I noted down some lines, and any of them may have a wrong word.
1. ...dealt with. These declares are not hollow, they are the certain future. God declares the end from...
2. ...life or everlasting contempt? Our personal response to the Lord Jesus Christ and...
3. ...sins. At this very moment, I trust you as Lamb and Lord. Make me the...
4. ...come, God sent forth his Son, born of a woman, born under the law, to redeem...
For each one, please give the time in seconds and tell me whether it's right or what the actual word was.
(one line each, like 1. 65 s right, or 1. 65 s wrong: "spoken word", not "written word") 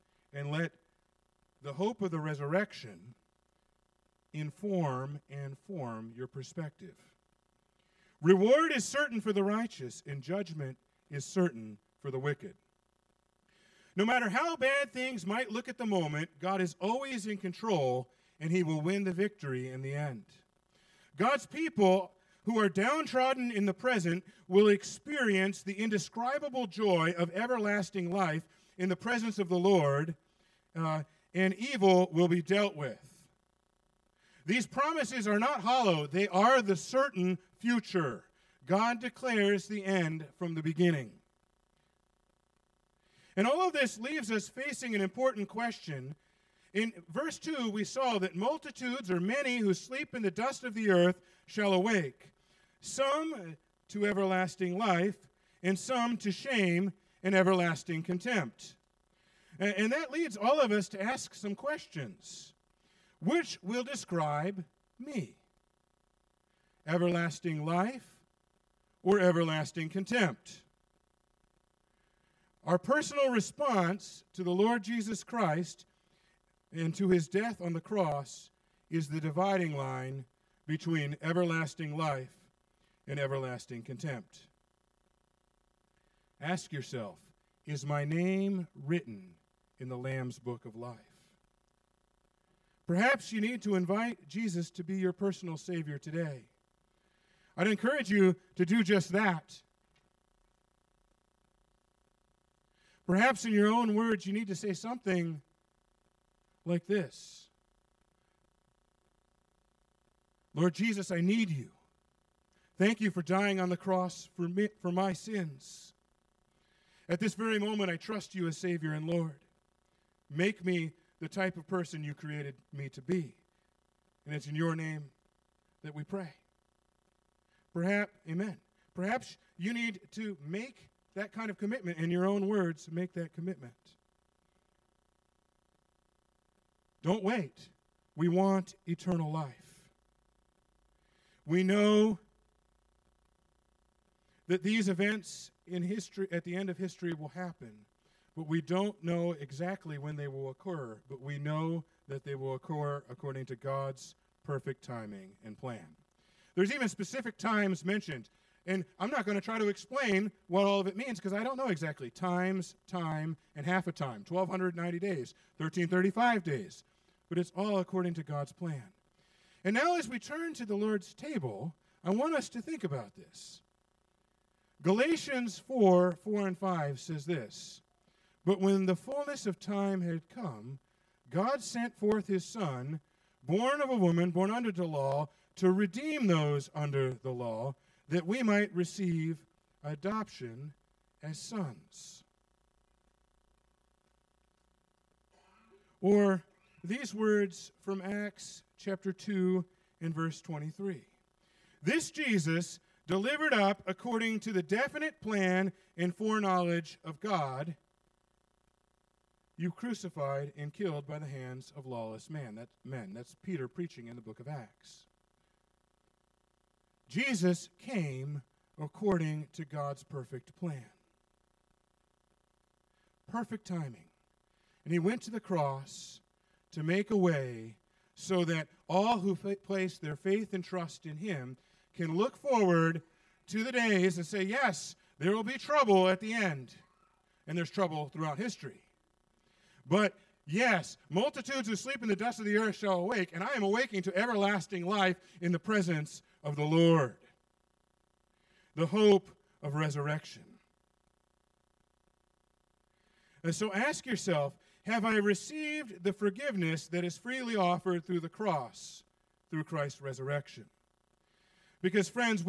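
1. 32 s wrong: "promises", not "declares"
2. 67 s right
3. 115 s wrong: "Savior", not "Lamb"
4. 180 s right.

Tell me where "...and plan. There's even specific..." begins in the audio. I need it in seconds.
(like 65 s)
155 s.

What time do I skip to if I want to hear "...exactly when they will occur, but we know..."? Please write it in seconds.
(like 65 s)
149 s.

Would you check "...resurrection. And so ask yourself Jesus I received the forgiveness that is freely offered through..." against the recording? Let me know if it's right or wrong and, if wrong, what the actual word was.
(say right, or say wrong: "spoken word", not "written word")
wrong: "Have", not "Jesus".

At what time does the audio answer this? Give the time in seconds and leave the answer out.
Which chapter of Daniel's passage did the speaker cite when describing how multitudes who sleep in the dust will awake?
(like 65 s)
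47 s.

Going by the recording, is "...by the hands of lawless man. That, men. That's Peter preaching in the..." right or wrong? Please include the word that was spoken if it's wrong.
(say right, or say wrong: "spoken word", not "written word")
right.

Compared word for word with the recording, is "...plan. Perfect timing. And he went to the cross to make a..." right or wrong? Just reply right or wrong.
right.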